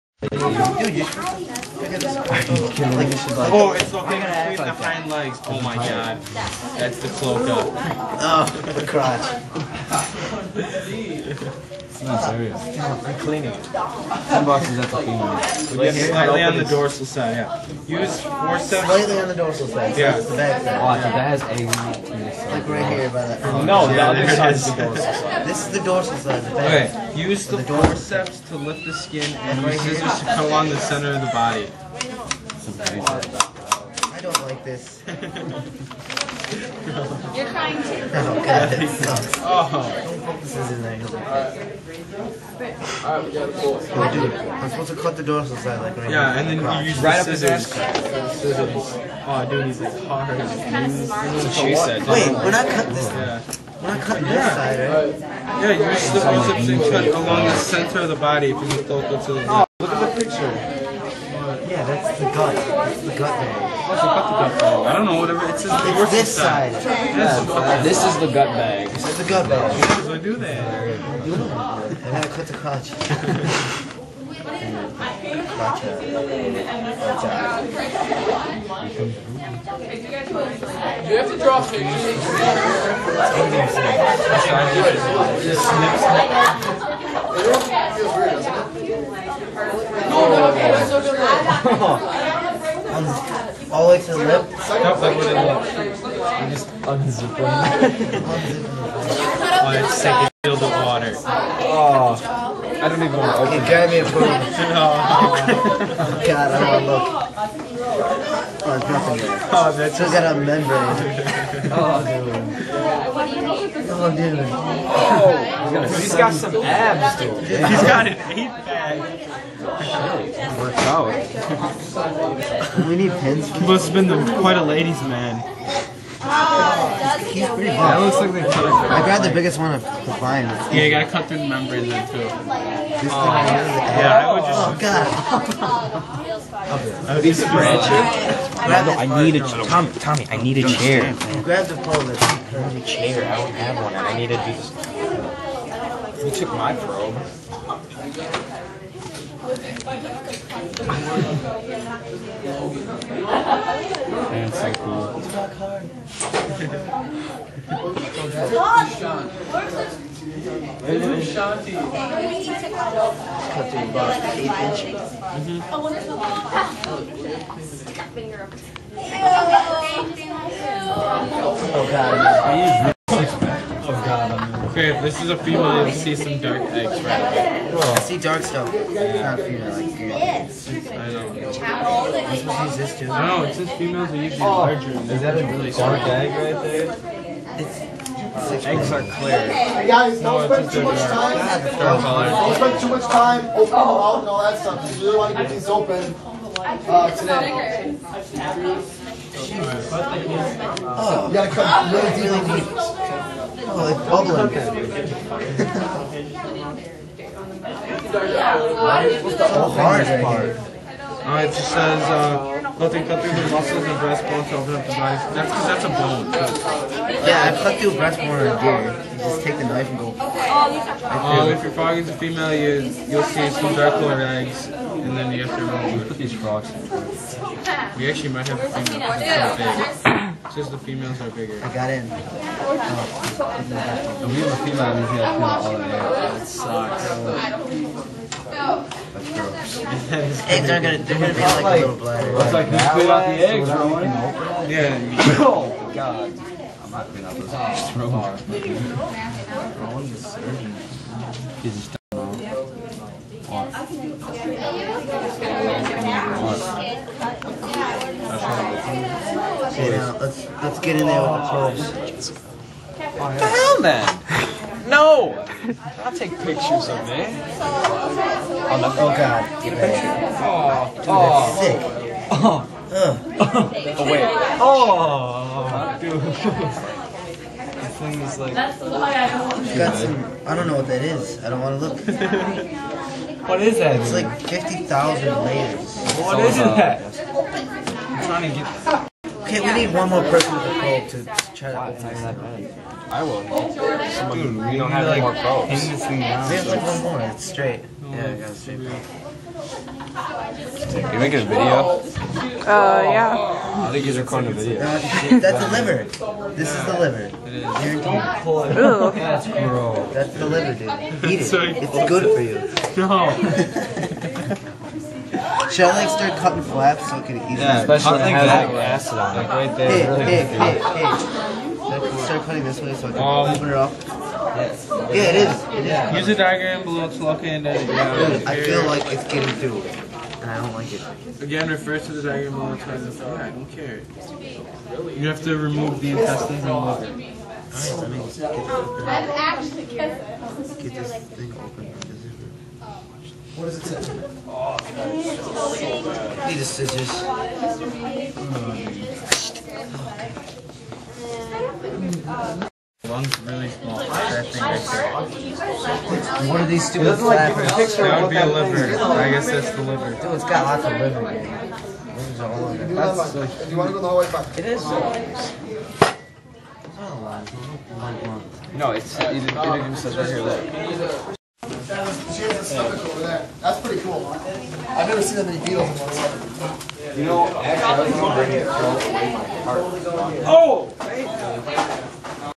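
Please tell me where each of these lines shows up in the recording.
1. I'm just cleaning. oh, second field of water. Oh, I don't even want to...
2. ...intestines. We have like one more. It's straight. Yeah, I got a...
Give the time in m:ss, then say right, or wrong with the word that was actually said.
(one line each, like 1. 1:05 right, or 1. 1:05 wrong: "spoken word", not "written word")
1. 1:36 wrong: "unzipping", not "cleaning"
2. 4:55 wrong: "probes", not "intestines".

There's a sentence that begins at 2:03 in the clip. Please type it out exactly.
Must have been the, quite a ladies' man.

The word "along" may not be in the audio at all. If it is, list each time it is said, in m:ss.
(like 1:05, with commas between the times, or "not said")
0:30, 0:57.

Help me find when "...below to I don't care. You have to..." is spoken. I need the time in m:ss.
5:32.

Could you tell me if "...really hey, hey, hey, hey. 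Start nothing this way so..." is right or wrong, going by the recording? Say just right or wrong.
wrong.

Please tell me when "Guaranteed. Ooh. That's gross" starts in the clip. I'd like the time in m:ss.
5:07.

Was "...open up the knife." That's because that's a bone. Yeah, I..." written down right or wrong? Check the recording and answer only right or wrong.
right.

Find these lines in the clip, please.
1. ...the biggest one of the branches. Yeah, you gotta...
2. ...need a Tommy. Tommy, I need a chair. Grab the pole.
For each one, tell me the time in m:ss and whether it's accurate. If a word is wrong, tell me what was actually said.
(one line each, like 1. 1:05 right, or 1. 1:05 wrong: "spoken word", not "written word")
1. 2:09 wrong: "vines", not "branches"
2. 2:19 right.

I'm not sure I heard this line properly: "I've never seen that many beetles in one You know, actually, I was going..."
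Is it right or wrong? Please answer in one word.
right.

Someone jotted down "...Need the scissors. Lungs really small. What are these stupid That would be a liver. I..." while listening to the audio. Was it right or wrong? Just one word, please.
right.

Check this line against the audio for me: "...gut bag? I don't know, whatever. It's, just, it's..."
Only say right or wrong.
right.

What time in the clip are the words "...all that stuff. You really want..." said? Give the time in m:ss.
3:14.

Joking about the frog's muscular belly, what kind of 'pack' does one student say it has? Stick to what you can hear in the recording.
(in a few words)
Eight pack.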